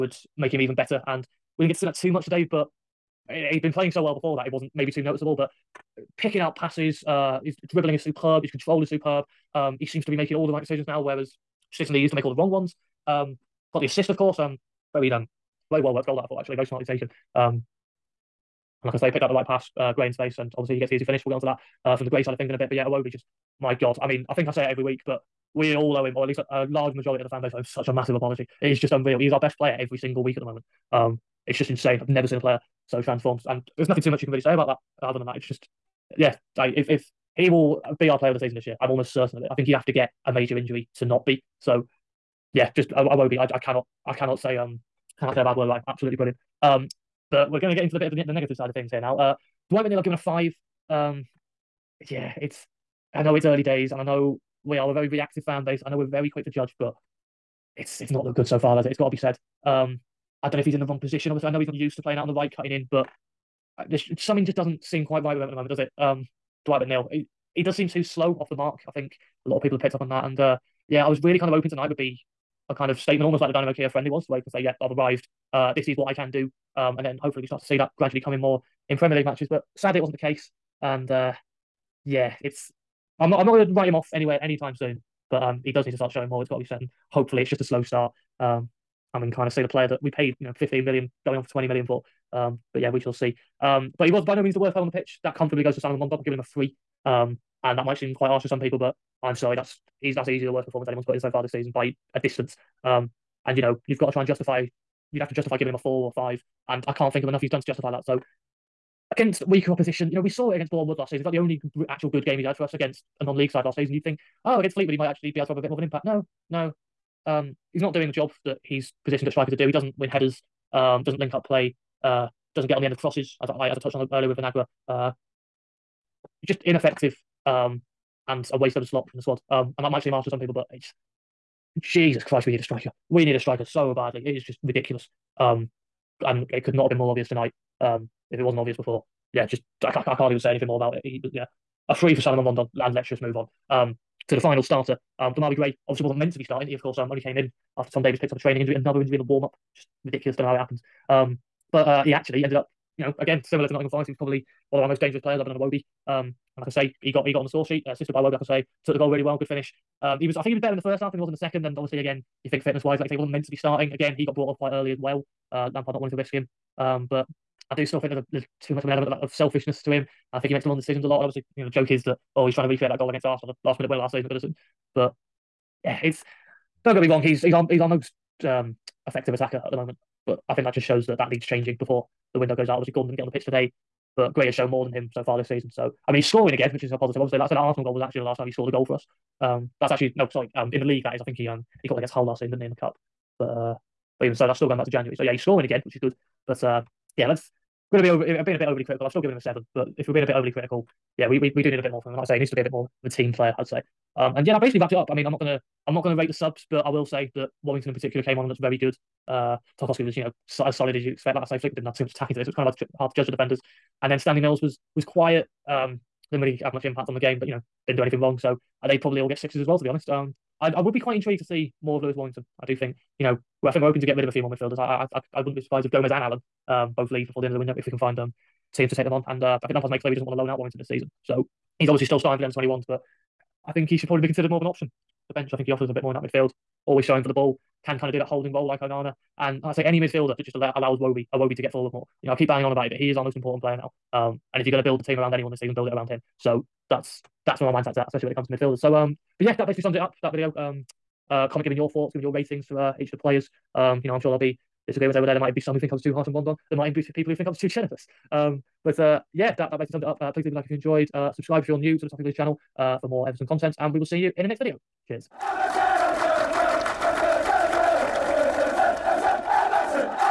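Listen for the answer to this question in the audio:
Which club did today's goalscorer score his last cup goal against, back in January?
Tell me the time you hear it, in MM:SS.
03:12.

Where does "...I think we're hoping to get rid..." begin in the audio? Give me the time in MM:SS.
03:43.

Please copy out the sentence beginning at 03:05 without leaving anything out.
So, I mean, he's scoring again, which is a positive.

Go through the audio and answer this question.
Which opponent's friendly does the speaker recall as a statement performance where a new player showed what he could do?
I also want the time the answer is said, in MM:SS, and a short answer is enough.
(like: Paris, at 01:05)
Dynamo Kiev, at 01:13.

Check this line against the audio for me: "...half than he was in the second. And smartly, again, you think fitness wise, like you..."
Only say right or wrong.
wrong.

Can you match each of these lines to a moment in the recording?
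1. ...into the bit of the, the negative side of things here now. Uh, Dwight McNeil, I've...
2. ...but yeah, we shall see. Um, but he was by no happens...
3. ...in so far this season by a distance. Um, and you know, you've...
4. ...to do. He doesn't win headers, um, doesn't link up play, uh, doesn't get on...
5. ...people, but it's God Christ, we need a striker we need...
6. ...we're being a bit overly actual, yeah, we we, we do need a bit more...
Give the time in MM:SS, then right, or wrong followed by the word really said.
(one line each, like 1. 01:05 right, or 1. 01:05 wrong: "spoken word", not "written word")
1. 00:47 right
2. 01:32 wrong: "means", not "happens"
3. 01:41 right
4. 01:59 right
5. 02:10 wrong: "Jesus", not "God"
6. 03:20 wrong: "critical", not "actual".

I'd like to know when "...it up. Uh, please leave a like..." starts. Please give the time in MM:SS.
04:20.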